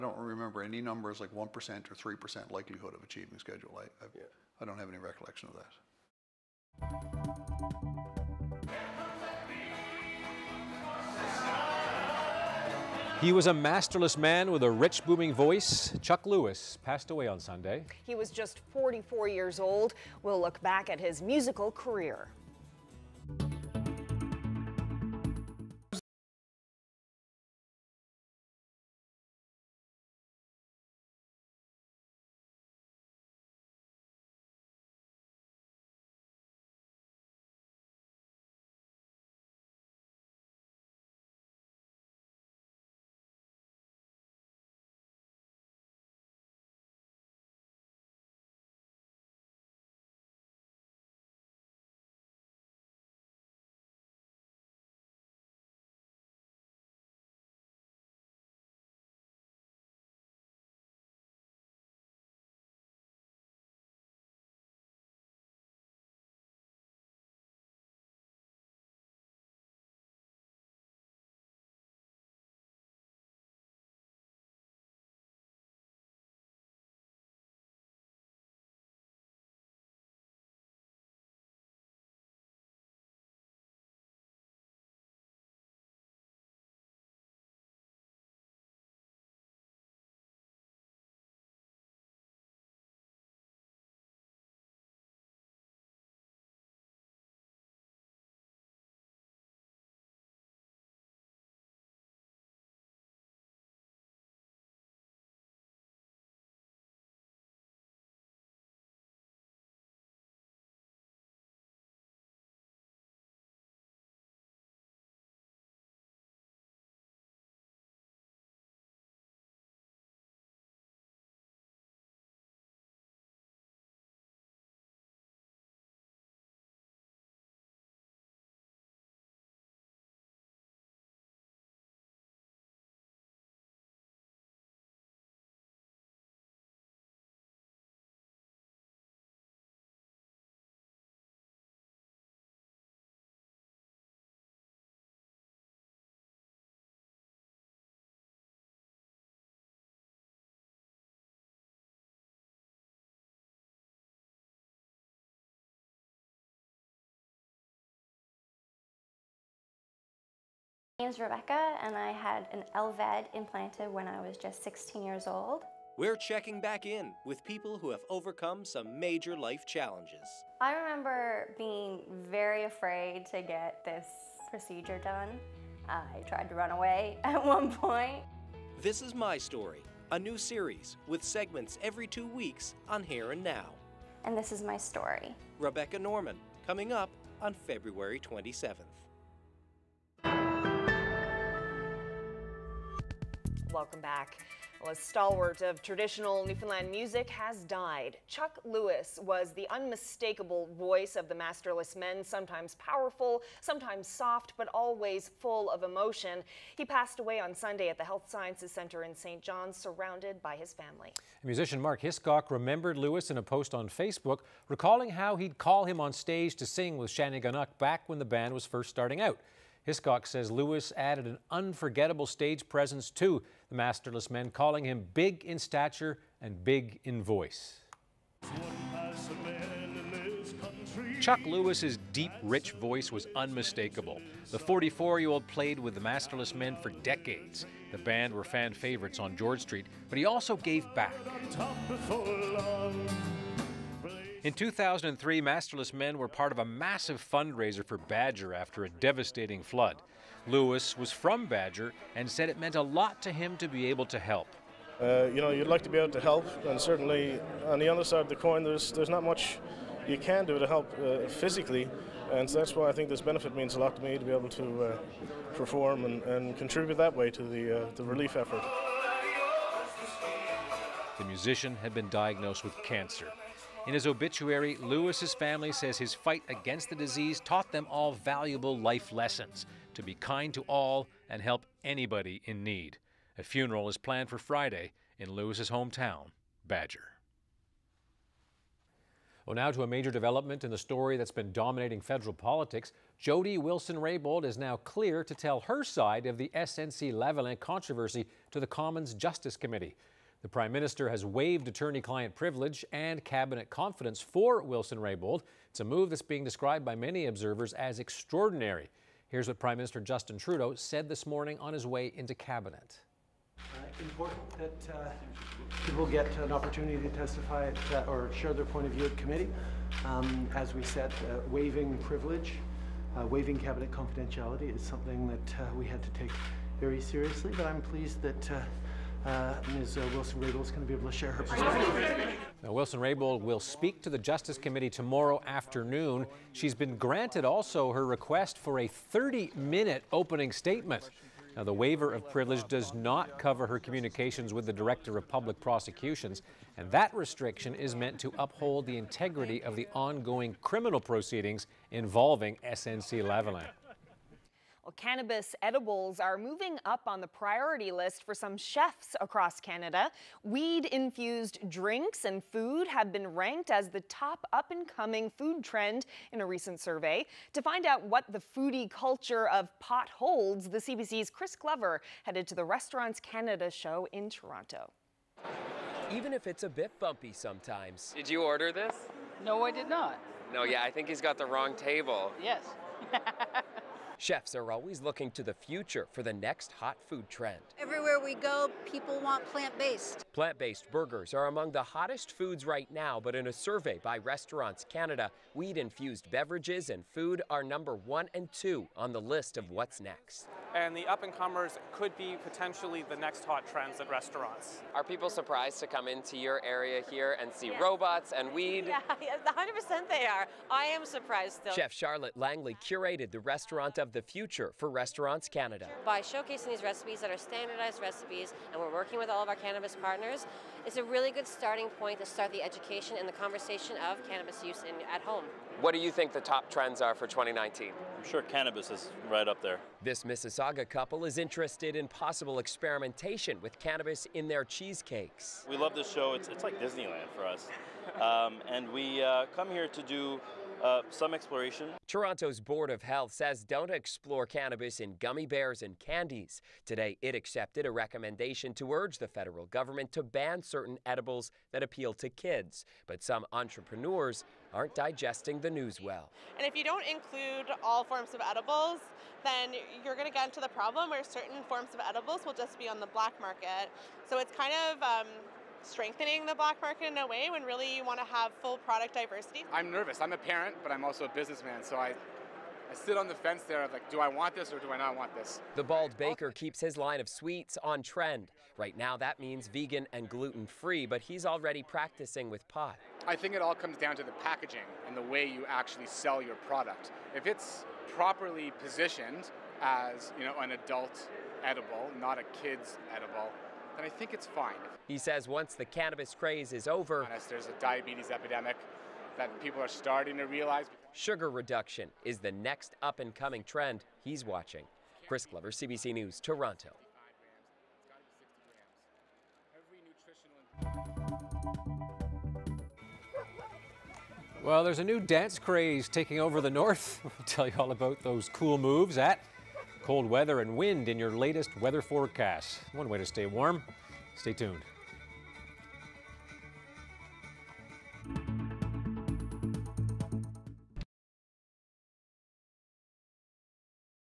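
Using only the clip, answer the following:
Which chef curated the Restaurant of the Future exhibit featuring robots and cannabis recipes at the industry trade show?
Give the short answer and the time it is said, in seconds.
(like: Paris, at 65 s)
Charlotte Langley, at 411 s.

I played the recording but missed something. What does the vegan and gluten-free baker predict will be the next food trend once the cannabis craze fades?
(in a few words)
Sugar reduction.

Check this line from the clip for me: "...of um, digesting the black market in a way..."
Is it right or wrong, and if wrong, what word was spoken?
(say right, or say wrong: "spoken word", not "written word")
wrong: "strengthening", not "digesting".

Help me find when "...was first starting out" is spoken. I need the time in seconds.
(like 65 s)
218 s.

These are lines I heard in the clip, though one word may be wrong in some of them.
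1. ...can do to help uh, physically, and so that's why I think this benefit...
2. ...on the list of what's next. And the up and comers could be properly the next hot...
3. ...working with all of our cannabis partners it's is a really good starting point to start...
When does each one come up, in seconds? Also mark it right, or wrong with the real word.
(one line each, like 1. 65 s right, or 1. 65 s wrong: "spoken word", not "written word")
1. 260 s right
2. 398 s wrong: "potentially", not "properly"
3. 418 s right.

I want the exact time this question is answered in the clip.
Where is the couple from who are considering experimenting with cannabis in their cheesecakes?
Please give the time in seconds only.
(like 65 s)
430 s.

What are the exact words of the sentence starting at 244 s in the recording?
In 2003, Masterless Men were part of a massive fundraiser for Badger after a devastating flood.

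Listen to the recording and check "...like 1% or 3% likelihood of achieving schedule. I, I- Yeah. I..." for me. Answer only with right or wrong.
right.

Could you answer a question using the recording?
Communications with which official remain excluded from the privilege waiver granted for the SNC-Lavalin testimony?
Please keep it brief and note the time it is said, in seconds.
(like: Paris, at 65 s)
Director of Public Prosecutions, at 344 s.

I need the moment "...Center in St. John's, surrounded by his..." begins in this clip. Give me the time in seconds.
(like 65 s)
208 s.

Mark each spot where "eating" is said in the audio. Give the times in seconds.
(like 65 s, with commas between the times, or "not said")
not said.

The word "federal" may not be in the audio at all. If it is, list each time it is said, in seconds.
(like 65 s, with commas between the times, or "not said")
292 s, 449 s.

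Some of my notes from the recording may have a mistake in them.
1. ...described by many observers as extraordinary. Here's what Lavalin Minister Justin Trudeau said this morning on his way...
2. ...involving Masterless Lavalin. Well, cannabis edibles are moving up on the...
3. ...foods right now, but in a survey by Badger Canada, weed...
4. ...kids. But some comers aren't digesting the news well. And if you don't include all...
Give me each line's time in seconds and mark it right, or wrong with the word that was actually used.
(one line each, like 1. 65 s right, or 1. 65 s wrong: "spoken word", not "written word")
1. 306 s wrong: "Prime", not "Lavalin"
2. 351 s wrong: "SNC", not "Masterless"
3. 392 s wrong: "Restaurants", not "Badger"
4. 452 s wrong: "entrepreneurs", not "comers".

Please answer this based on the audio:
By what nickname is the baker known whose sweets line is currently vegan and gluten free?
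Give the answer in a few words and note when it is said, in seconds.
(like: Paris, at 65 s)
The Bald Baker, at 475 s.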